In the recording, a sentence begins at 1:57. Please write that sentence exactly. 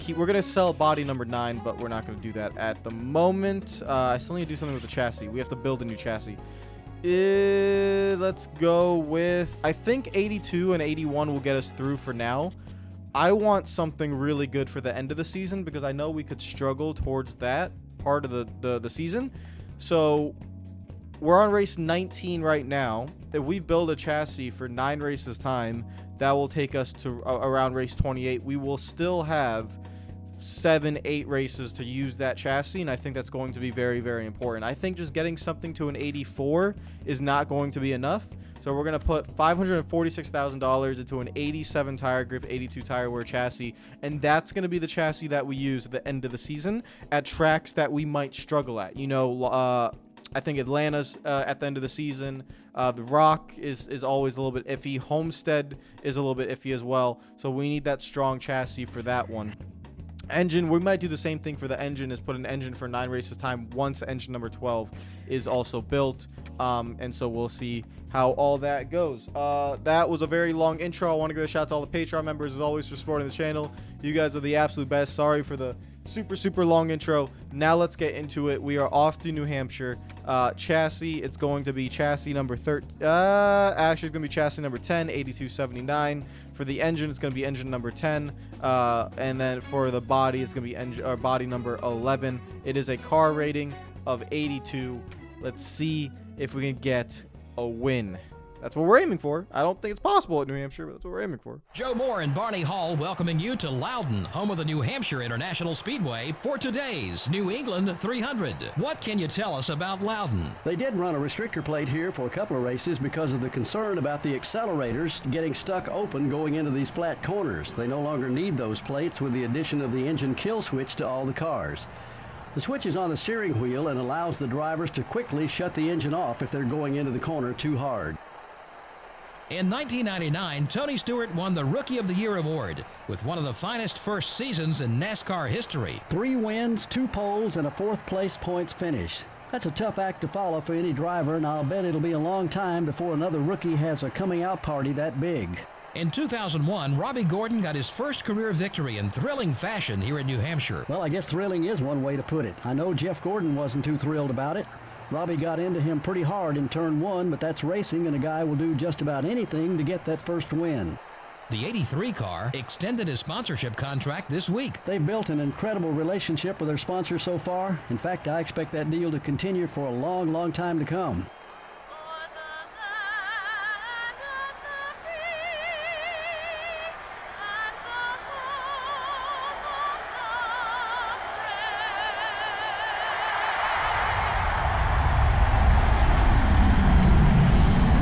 They no longer need those plates with the addition of the engine kill switch to all the cars.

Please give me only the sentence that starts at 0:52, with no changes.
Uh, the Rock is is always a little bit iffy.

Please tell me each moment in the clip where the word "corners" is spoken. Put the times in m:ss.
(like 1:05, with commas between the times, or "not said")
1:57, 2:07.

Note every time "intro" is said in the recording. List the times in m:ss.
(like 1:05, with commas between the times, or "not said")
1:10, 1:16.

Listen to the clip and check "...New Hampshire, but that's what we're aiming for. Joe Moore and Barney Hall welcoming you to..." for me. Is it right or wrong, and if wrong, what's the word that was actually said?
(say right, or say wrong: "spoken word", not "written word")
right.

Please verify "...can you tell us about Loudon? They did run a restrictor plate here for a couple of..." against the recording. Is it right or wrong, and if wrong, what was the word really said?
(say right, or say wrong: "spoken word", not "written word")
right.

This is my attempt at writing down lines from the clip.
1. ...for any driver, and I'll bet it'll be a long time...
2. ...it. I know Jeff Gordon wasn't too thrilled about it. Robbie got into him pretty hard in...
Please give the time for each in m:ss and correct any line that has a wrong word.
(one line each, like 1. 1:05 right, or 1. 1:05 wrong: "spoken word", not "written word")
1. 2:20 right
2. 2:32 right.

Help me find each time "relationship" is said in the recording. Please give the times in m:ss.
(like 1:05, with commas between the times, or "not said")
2:45.